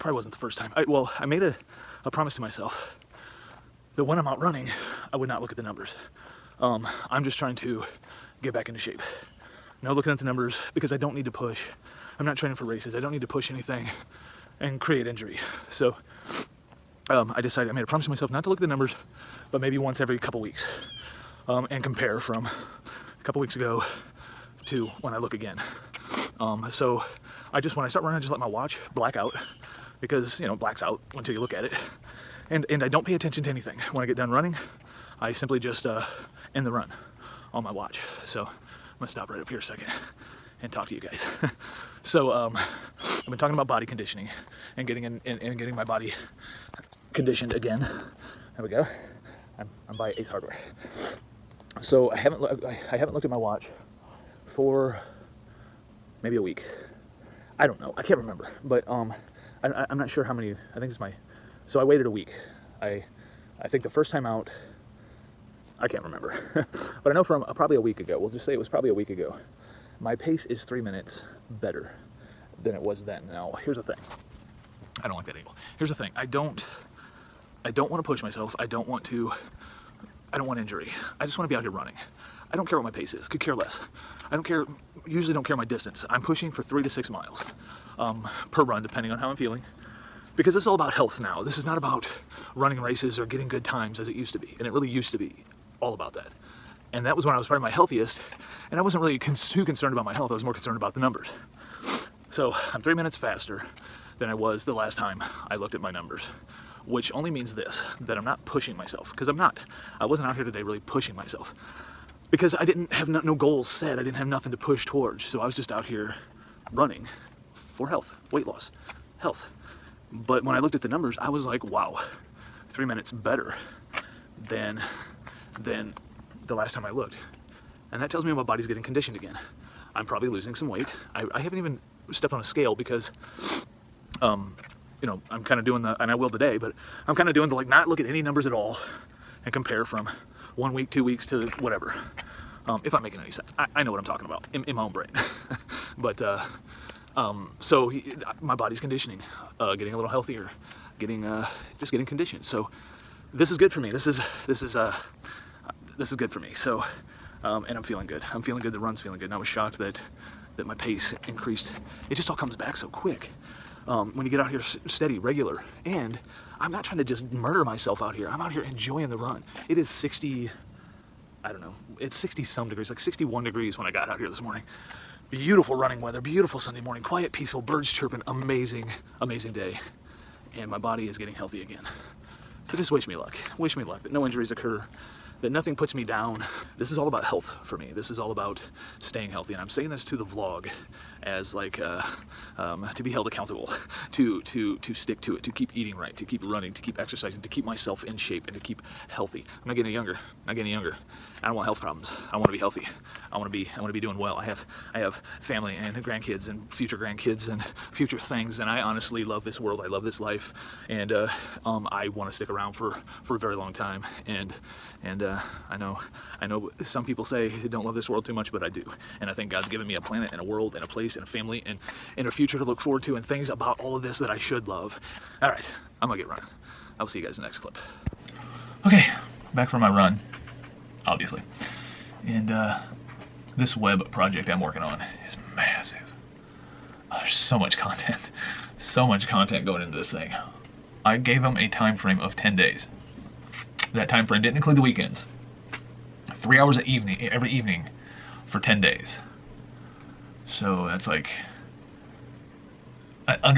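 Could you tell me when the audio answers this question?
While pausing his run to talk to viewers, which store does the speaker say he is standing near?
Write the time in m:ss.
0:50.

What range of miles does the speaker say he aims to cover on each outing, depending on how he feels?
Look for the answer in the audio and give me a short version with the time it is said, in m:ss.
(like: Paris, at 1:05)
3 to 6 miles, at 1:26.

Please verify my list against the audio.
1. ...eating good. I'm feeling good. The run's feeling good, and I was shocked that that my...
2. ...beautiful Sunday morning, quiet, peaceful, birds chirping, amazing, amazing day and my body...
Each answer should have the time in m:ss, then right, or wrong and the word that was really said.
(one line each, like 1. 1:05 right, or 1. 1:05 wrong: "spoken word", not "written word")
1. 2:37 wrong: "feeling", not "eating"
2. 2:56 right.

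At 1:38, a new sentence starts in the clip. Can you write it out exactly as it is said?
And I wasn't really too concerned about my health.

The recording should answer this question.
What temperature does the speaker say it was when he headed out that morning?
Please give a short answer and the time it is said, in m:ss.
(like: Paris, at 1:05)
61 degrees, at 2:52.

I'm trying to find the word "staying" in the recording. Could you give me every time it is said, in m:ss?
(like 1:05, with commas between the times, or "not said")
3:08.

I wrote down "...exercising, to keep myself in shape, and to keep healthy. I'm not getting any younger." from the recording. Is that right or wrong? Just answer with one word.
right.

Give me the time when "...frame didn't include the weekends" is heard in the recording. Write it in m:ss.
4:04.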